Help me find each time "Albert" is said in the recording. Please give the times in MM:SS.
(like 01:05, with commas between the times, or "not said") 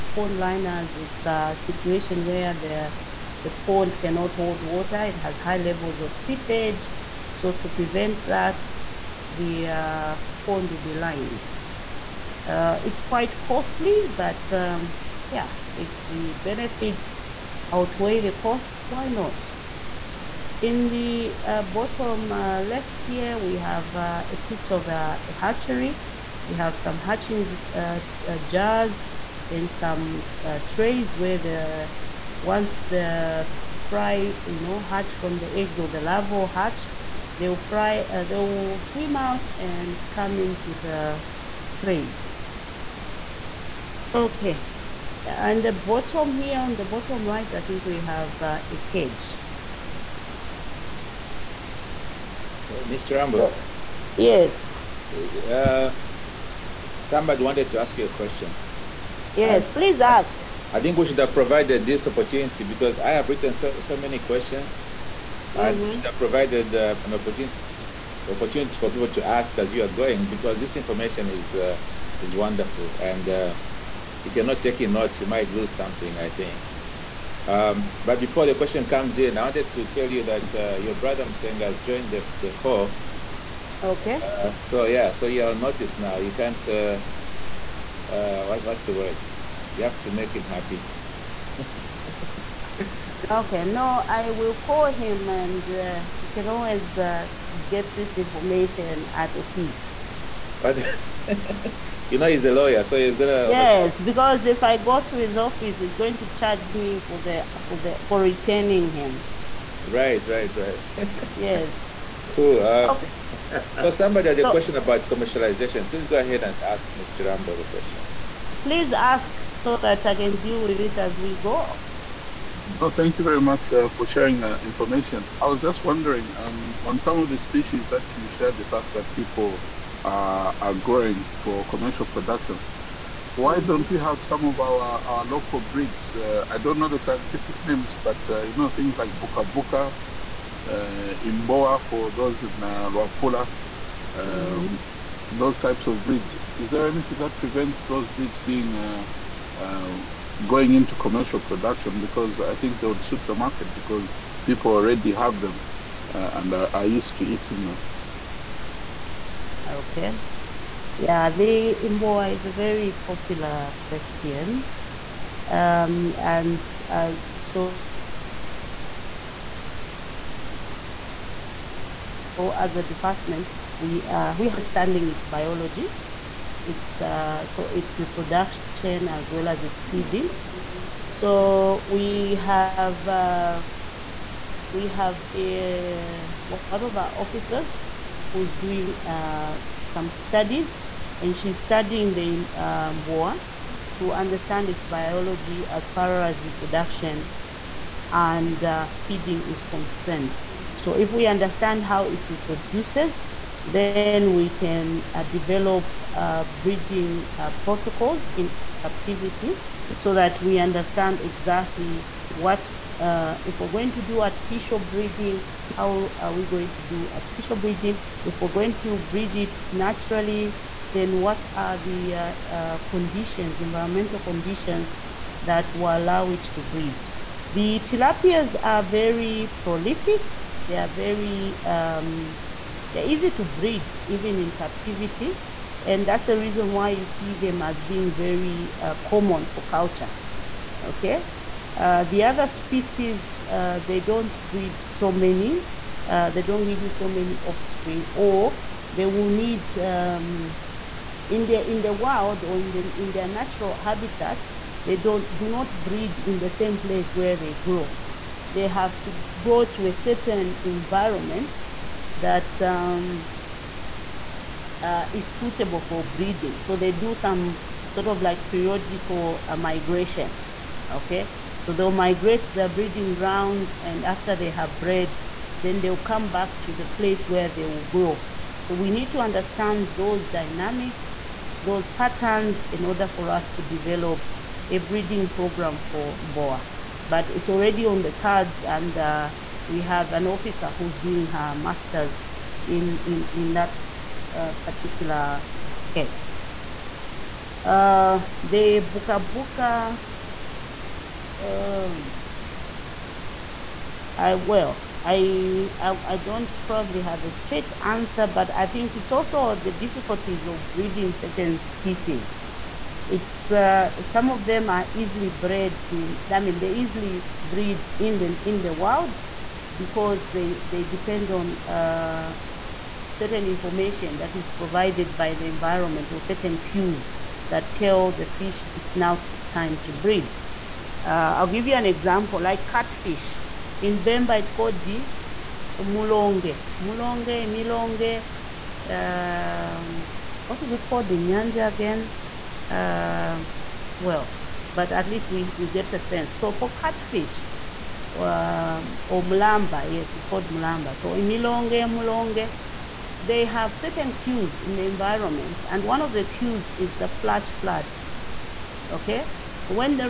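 not said.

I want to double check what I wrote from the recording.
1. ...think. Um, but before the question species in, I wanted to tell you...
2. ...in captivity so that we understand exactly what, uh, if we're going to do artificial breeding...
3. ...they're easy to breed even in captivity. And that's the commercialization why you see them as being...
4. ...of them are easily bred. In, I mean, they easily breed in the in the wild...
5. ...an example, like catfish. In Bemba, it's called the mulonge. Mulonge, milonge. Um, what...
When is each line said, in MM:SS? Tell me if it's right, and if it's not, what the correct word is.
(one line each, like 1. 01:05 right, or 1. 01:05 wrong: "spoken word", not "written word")
1. 01:16 wrong: "comes", not "species"
2. 03:28 right
3. 03:52 wrong: "reason", not "commercialization"
4. 05:14 right
5. 05:31 right.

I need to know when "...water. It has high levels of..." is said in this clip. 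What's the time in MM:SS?
00:04.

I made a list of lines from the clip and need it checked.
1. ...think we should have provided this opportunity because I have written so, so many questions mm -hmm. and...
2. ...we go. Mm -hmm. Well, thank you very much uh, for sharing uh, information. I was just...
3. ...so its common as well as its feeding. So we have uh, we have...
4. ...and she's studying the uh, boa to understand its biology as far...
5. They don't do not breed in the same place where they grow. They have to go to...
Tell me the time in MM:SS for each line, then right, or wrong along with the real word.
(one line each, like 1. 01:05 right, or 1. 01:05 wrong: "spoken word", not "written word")
1. 01:00 right
2. 02:01 right
3. 02:57 wrong: "reproduction", not "common"
4. 03:11 right
5. 04:14 right.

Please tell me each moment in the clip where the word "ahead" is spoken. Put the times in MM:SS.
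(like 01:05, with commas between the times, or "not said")
01:56.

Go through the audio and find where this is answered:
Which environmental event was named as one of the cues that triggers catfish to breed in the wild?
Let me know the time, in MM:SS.
05:57.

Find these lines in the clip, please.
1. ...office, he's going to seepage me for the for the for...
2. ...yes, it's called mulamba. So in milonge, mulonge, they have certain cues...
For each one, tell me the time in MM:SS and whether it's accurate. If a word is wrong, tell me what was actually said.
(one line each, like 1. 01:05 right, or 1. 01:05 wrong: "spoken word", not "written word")
1. 01:45 wrong: "charge", not "seepage"
2. 05:49 right.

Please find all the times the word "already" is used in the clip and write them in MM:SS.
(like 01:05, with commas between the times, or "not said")
02:34, 04:47.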